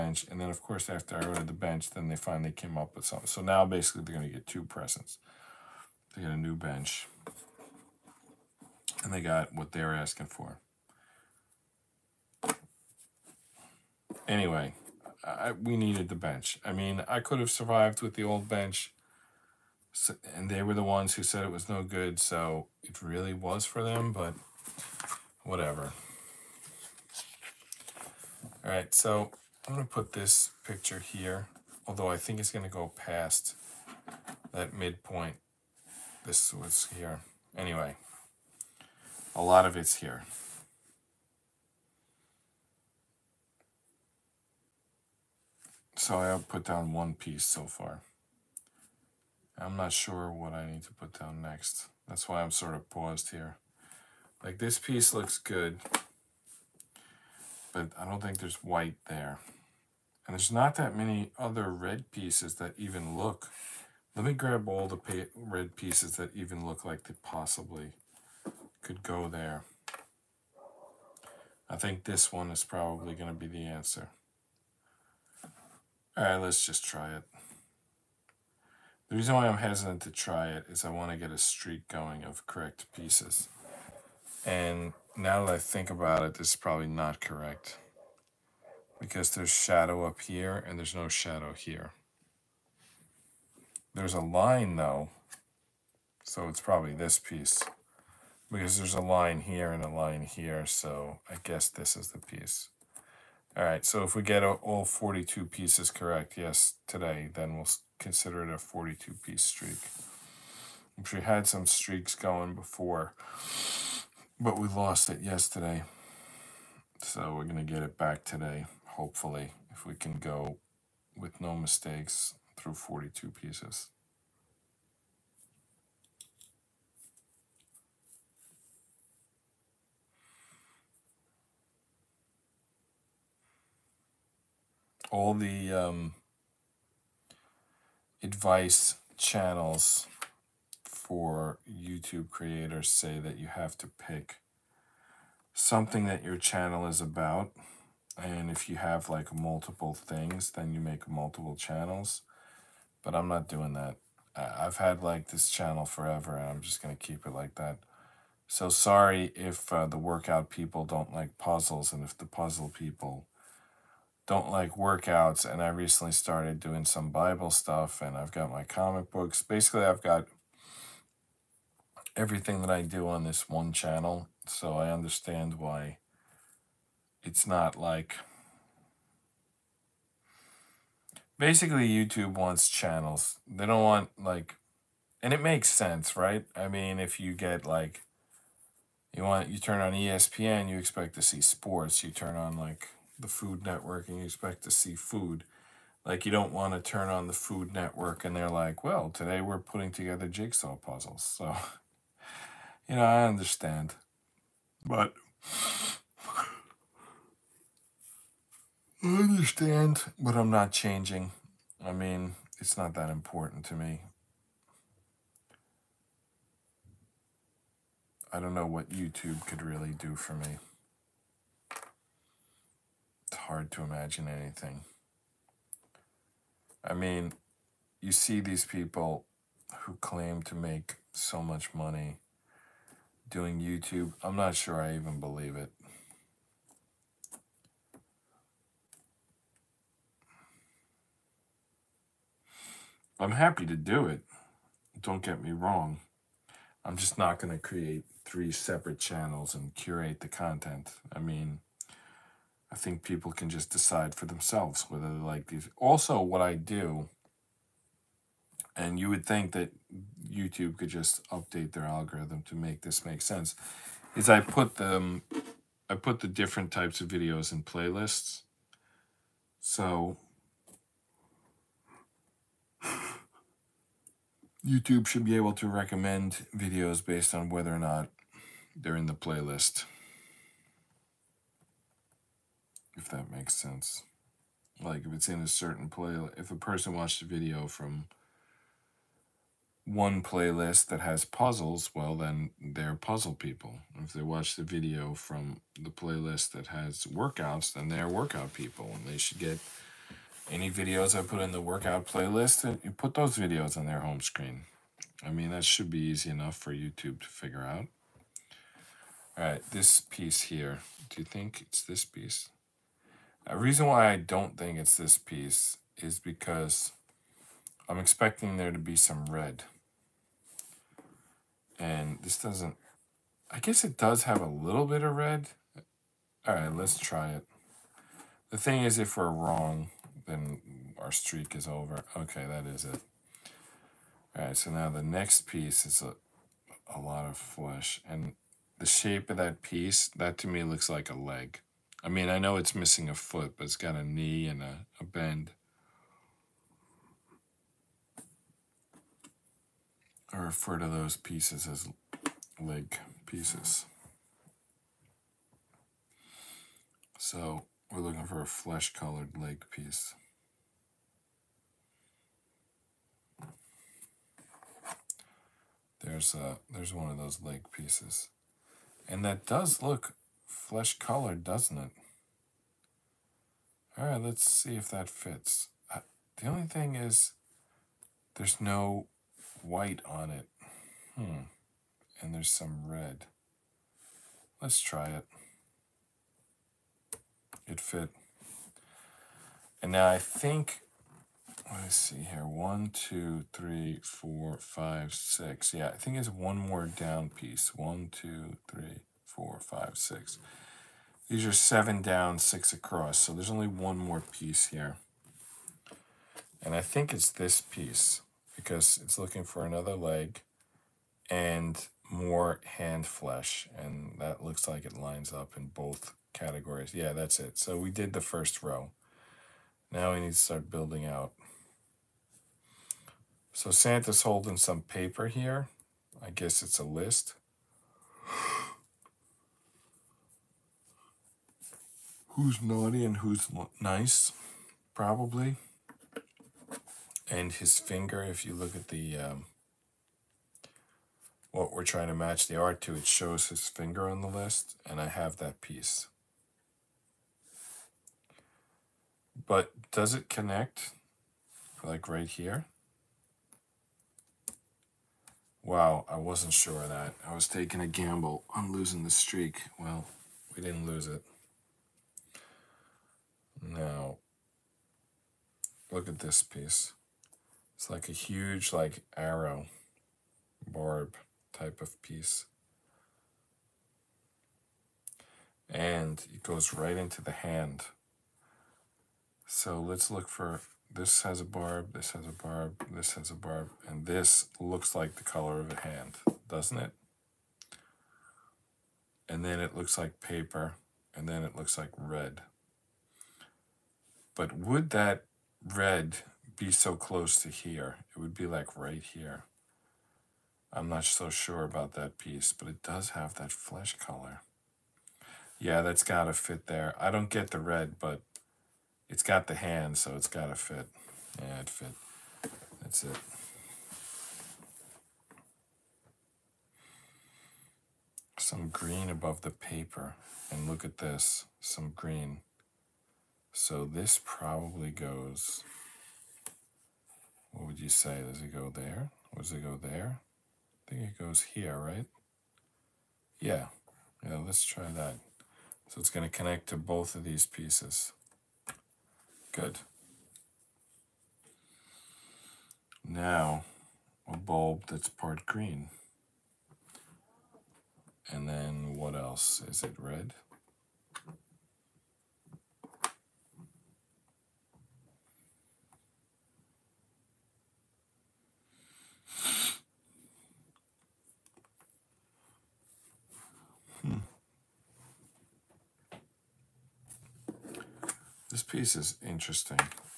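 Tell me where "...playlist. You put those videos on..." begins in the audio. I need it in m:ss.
5:02.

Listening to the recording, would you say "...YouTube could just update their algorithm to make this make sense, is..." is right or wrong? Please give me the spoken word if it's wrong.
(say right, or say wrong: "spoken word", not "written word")
right.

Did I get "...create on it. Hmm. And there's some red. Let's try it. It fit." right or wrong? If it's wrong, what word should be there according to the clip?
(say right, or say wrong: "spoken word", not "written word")
wrong: "white", not "create".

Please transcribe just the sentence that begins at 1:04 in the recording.
Let me grab all the red pieces that even look like they possibly could go there.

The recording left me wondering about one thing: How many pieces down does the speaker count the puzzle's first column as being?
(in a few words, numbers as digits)
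7.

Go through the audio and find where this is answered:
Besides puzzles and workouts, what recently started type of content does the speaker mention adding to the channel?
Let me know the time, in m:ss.
2:47.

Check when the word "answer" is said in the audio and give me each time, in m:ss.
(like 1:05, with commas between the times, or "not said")
1:13.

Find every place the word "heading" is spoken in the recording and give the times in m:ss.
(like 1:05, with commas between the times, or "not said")
not said.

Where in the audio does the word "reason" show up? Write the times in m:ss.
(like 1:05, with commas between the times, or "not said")
1:19, 5:13.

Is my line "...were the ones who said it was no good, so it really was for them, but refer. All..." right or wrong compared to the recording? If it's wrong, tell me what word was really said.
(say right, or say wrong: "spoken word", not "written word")
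wrong: "whatever", not "refer".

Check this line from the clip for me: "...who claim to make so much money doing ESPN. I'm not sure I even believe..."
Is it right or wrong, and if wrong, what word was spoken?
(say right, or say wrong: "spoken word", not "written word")
wrong: "YouTube", not "ESPN".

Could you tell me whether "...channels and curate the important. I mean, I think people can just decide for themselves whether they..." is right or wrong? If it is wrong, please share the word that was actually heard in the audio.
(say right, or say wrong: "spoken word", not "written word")
wrong: "content", not "important".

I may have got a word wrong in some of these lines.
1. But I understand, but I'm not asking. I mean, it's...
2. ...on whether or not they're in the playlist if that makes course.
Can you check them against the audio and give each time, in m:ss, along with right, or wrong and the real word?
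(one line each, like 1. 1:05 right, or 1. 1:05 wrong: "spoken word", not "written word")
1. 3:24 wrong: "changing", not "asking"
2. 4:37 wrong: "sense", not "course".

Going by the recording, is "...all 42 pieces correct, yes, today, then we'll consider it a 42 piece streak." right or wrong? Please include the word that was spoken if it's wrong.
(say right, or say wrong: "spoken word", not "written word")
right.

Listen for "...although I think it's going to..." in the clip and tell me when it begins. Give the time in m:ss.
0:31.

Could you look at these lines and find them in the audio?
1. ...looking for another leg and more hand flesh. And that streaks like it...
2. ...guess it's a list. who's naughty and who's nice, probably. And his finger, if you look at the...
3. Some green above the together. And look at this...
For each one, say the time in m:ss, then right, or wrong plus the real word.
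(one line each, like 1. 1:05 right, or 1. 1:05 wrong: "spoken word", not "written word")
1. 6:49 wrong: "looks", not "streaks"
2. 7:06 right
3. 8:38 wrong: "paper", not "together".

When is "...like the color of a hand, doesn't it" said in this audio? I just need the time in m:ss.
8:04.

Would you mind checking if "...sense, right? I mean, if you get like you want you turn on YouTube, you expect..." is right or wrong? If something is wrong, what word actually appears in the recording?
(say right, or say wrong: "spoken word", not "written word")
wrong: "ESPN", not "YouTube".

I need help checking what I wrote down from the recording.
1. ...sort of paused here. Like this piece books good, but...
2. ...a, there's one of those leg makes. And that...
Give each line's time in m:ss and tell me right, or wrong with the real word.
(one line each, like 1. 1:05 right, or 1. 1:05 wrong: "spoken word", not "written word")
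1. 0:52 wrong: "looks", not "books"
2. 6:06 wrong: "pieces", not "makes".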